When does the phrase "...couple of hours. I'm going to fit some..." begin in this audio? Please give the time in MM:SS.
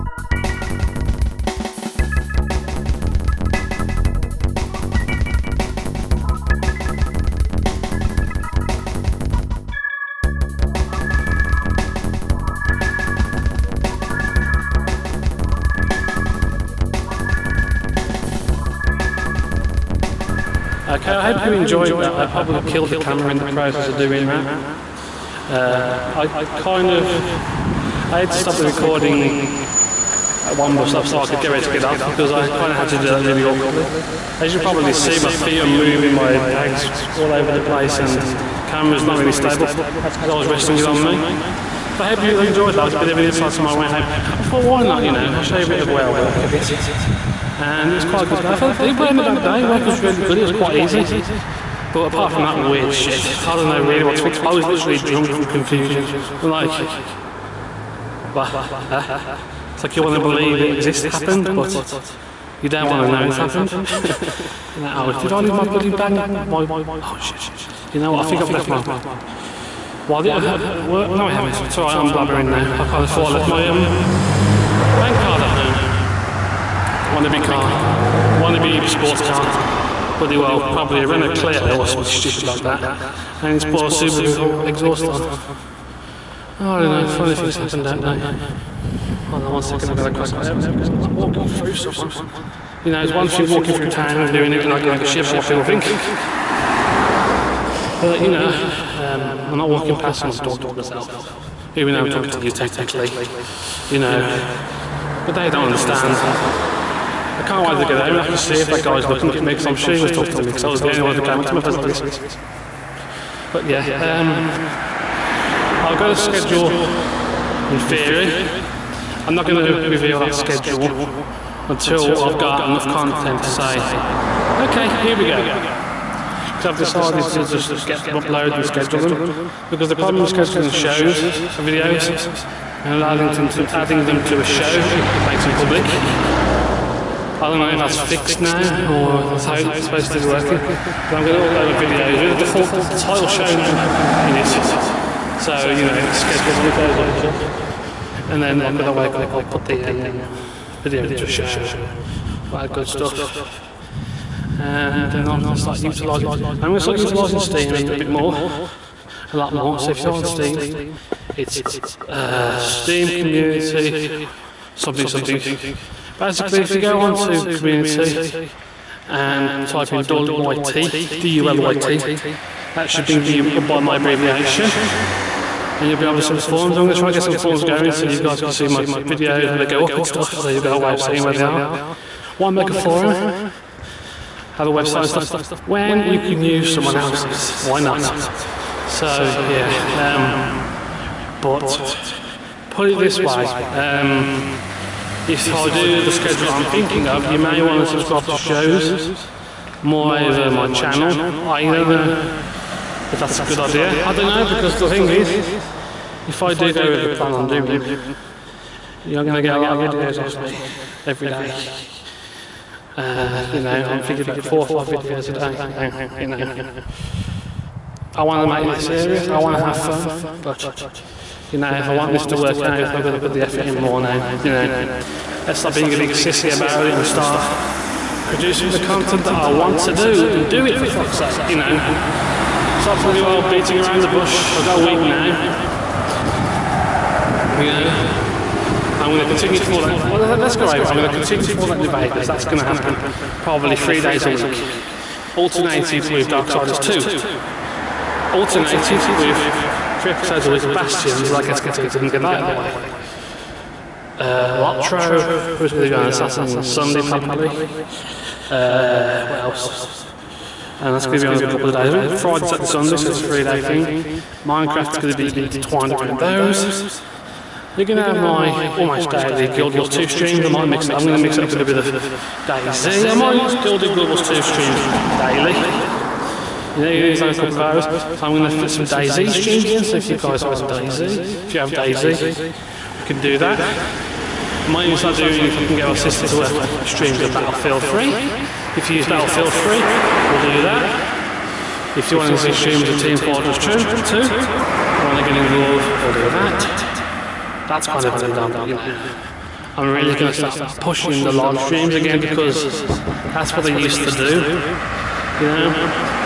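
04:37.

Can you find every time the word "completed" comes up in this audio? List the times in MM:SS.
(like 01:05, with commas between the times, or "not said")
04:11.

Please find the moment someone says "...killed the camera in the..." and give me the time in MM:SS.
00:22.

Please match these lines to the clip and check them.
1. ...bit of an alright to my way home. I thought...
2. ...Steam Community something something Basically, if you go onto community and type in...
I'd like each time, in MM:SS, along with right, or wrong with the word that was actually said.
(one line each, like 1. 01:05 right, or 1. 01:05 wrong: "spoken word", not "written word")
1. 00:42 wrong: "insight", not "alright"
2. 02:42 right.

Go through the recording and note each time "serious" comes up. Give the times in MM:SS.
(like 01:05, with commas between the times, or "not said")
03:38.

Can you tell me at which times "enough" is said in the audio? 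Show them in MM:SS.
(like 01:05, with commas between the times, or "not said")
02:02.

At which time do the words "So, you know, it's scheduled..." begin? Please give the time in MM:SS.
02:25.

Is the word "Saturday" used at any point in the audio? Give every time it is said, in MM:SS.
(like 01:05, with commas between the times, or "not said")
04:16, 04:22.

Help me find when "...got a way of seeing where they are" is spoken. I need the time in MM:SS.
03:00.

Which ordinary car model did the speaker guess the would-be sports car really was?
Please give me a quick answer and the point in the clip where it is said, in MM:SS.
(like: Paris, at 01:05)
Renault Clio, at 01:21.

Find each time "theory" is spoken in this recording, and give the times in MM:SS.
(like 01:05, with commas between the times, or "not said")
01:57.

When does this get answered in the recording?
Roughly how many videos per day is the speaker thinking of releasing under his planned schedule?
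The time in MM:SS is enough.
03:34.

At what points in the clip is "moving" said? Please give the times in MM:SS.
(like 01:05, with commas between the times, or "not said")
00:35.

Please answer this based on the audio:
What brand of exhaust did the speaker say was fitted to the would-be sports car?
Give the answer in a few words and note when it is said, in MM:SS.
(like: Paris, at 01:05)
Subaru, at 01:24.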